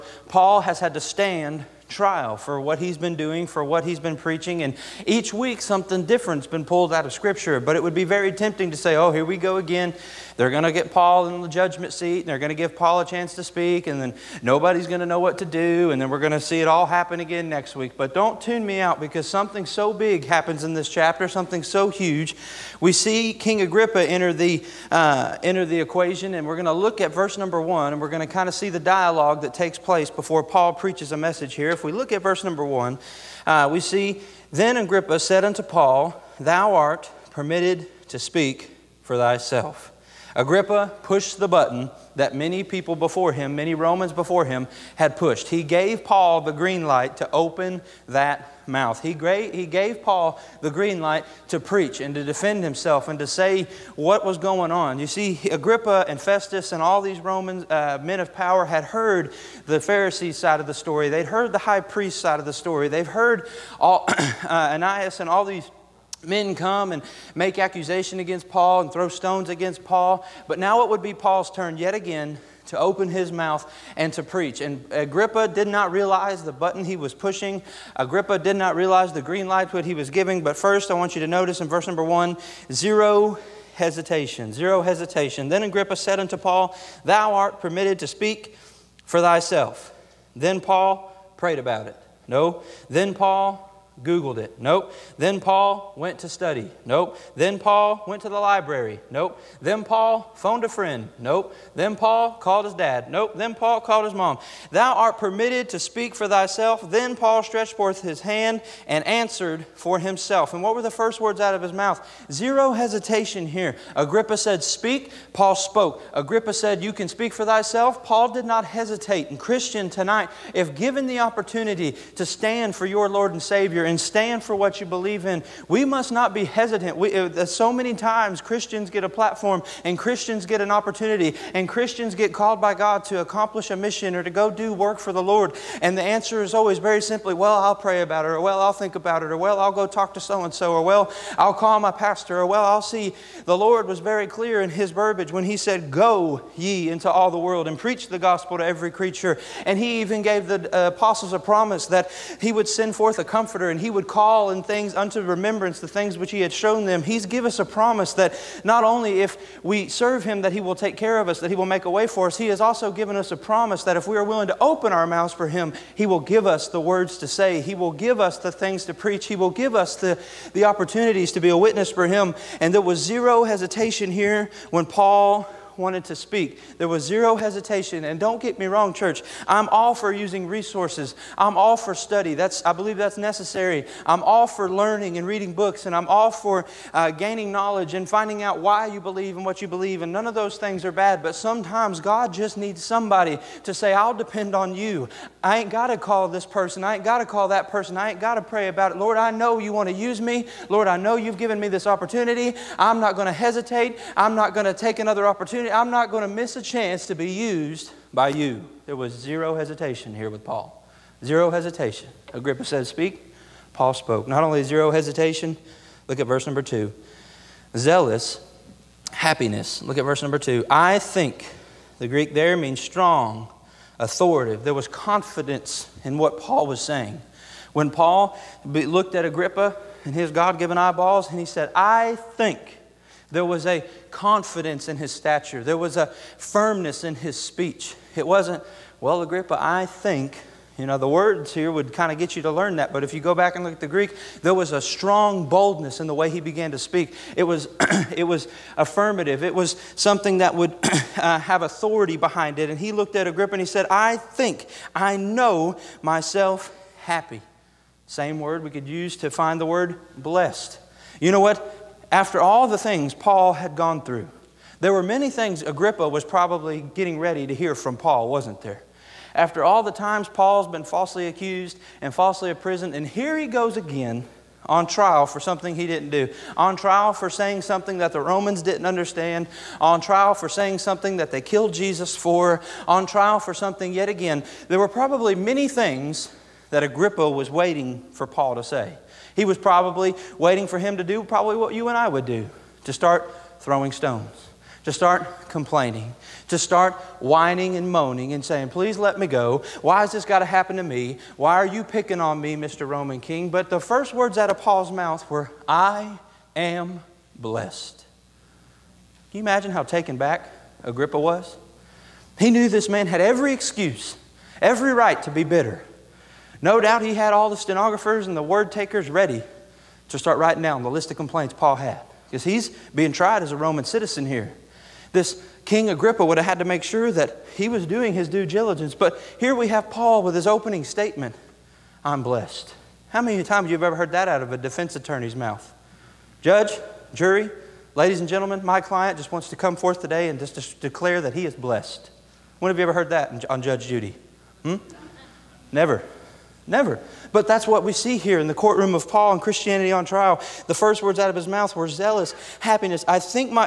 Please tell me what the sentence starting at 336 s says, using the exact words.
Judge, jury, ladies and gentlemen, my client just wants to come forth today and just declare that he is blessed.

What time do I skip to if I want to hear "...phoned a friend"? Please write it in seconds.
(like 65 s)
100 s.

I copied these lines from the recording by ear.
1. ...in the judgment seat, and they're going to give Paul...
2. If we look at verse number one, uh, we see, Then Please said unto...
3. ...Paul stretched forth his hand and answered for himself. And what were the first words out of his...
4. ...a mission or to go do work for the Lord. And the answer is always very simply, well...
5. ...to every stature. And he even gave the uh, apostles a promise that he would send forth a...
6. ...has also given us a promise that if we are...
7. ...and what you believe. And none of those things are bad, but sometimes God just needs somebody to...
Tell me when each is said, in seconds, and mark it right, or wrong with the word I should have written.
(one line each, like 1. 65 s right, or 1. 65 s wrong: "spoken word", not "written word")
1. 11 s right
2. 31 s wrong: "Agrippa", not "Please"
3. 107 s right
4. 133 s right
5. 148 s wrong: "creature", not "stature"
6. 162 s right
7. 189 s right.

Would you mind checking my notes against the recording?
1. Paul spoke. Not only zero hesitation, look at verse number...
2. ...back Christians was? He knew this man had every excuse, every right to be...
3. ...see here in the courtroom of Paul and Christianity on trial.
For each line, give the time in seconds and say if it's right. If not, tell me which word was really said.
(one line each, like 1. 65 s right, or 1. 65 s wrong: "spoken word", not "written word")
1. 213 s right
2. 310 s wrong: "Agrippa", not "Christians"
3. 347 s right.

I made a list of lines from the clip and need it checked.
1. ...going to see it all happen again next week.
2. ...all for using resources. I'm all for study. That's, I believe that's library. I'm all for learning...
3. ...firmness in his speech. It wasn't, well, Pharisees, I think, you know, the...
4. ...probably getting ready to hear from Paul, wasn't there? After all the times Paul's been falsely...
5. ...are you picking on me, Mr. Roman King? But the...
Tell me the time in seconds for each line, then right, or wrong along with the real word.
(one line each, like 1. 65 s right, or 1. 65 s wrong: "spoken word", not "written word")
1. 16 s right
2. 179 s wrong: "necessary", not "library"
3. 236 s wrong: "Agrippa", not "Pharisees"
4. 266 s right
5. 301 s right.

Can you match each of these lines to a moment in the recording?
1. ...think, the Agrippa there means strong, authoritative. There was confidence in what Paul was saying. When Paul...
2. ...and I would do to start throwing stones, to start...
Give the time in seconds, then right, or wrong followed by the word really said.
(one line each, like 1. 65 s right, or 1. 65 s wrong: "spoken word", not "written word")
1. 220 s wrong: "Greek", not "Agrippa"
2. 291 s right.